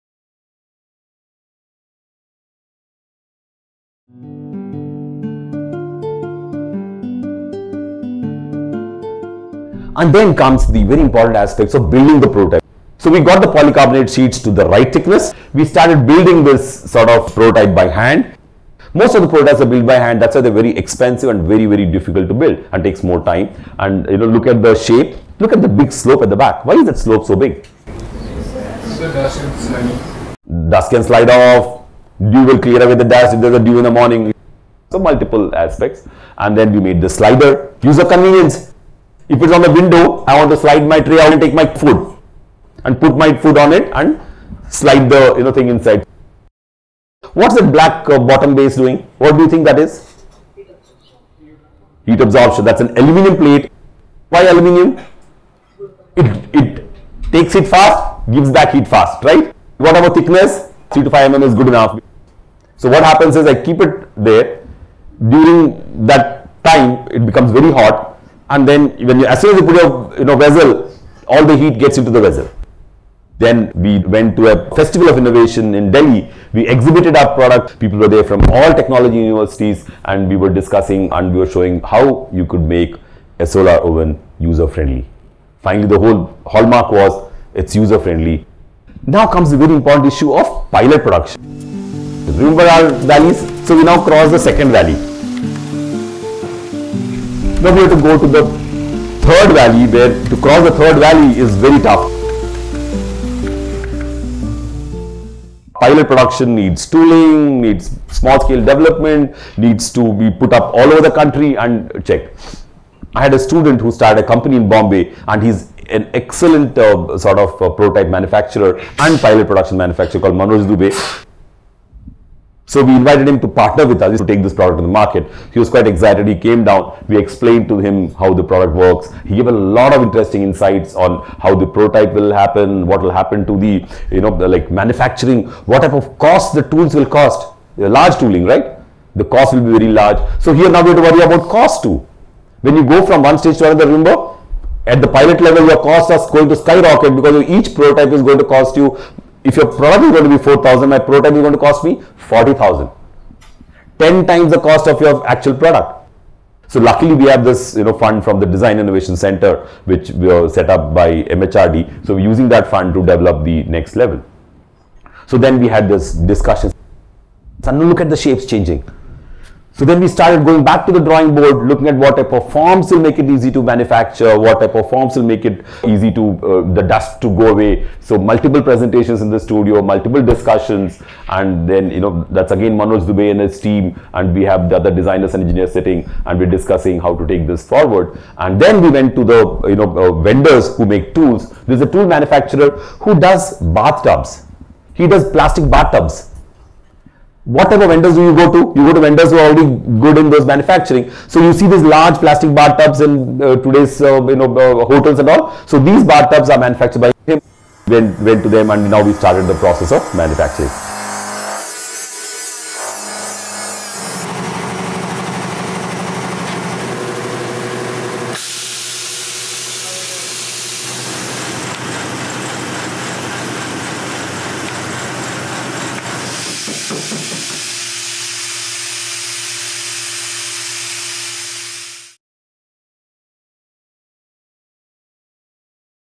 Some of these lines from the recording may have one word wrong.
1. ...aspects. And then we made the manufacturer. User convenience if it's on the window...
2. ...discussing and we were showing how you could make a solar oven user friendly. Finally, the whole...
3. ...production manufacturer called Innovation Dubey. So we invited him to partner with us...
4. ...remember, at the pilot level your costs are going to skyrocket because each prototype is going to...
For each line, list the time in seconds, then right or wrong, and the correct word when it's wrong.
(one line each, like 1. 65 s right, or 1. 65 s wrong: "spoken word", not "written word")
1. 35 s wrong: "slider", not "manufacturer"
2. 80 s right
3. 119 s wrong: "Manoj", not "Innovation"
4. 143 s right.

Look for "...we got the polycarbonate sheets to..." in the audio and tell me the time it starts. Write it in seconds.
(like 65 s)
13 s.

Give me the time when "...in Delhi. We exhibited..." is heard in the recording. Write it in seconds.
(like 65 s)
75 s.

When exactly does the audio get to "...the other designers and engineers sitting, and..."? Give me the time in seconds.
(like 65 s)
184 s.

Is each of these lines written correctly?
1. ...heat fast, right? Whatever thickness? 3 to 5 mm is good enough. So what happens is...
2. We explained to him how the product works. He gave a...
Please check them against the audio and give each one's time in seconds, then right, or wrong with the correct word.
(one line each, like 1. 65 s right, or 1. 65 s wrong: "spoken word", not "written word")
1. 58 s right
2. 127 s right.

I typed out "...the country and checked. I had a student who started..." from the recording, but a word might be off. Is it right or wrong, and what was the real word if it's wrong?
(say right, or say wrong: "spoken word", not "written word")
right.